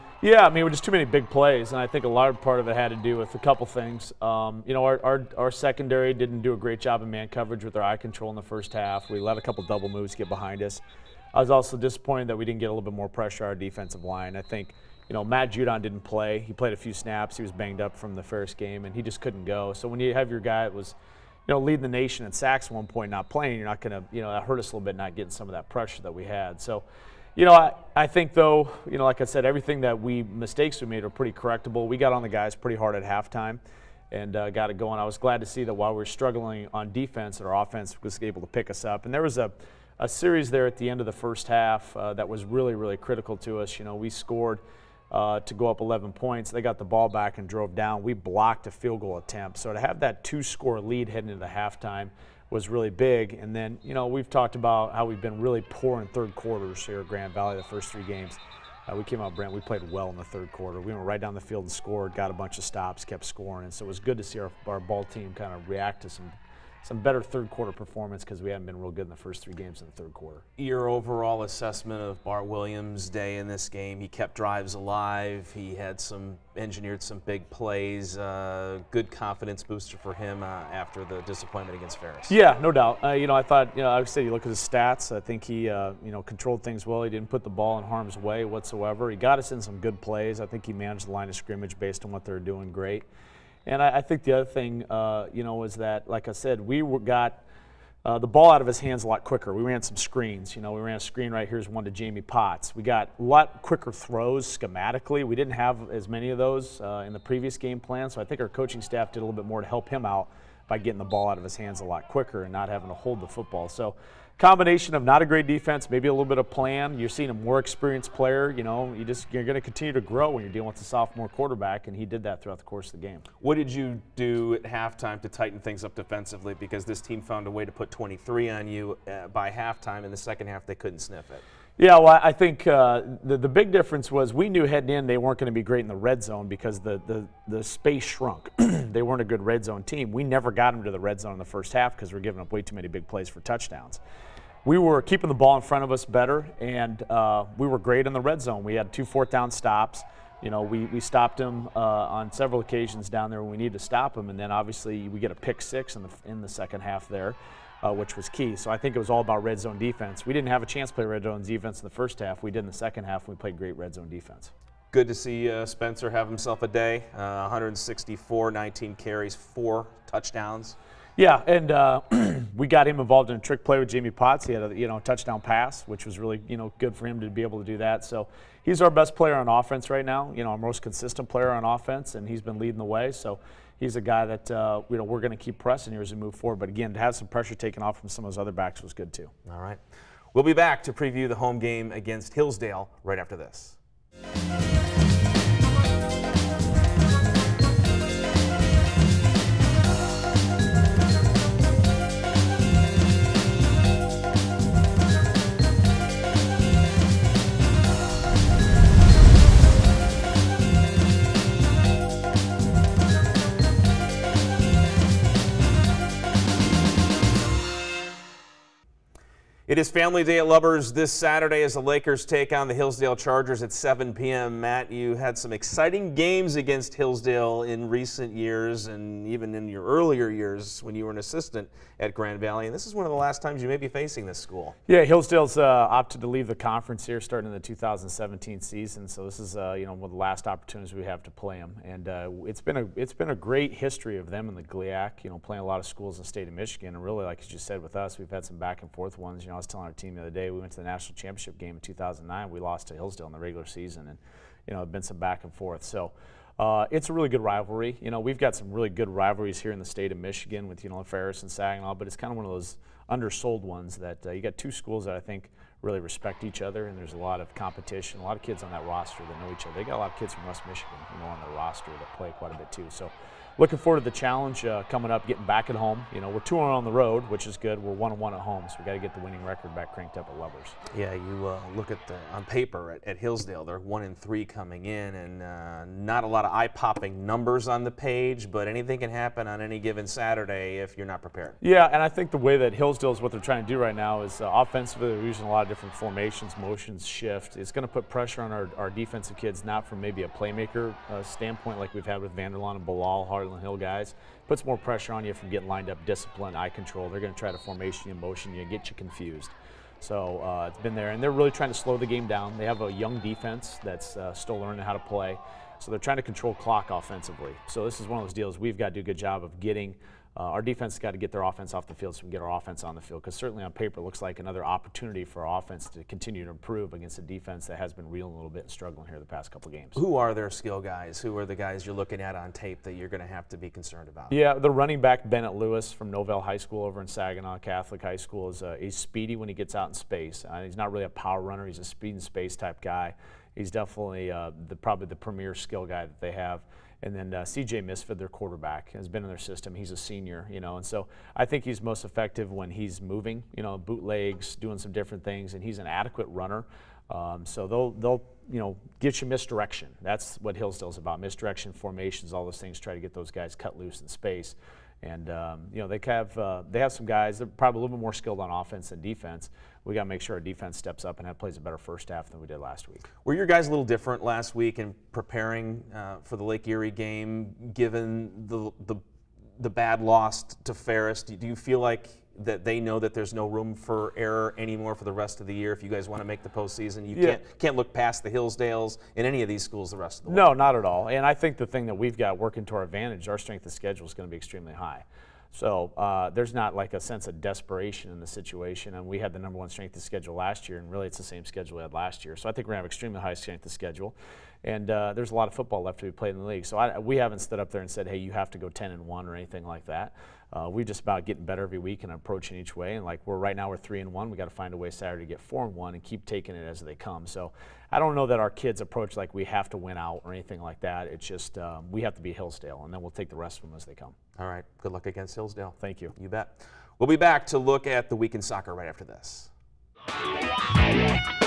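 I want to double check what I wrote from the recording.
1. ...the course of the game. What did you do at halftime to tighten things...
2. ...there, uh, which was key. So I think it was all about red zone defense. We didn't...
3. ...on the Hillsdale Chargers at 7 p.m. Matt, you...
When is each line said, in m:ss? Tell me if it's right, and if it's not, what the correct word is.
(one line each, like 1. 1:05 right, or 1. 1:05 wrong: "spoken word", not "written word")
1. 2:02 right
2. 2:37 right
3. 3:42 right.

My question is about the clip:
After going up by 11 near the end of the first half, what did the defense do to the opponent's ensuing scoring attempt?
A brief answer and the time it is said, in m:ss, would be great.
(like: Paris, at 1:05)
Blocked a field goal, at 0:48.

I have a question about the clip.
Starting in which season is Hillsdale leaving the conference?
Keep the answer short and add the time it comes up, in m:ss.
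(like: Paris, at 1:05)
2017, at 3:57.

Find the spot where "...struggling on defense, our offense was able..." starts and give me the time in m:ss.
0:36.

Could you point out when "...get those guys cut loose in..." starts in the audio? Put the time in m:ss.
6:03.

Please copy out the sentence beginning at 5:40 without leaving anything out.
Uh, he's not really a power runner.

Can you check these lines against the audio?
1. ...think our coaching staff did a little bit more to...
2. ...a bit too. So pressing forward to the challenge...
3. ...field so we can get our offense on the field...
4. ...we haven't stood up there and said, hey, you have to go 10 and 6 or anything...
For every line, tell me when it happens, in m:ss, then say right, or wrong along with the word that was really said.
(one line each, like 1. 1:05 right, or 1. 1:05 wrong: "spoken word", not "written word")
1. 1:48 right
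2. 4:32 wrong: "looking", not "pressing"
3. 5:21 right
4. 6:46 wrong: "1", not "6".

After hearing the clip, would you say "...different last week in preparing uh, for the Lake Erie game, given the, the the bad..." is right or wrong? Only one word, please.
right.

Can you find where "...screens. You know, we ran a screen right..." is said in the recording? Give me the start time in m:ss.
1:39.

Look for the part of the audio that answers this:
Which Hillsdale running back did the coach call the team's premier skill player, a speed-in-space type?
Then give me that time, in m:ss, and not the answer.
5:35.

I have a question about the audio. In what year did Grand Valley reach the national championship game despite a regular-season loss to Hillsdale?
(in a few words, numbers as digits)
2009.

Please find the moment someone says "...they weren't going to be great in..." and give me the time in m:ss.
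2:15.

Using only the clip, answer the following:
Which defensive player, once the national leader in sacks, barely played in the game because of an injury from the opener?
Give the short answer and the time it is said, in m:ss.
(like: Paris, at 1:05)
Matt Judon, at 0:15.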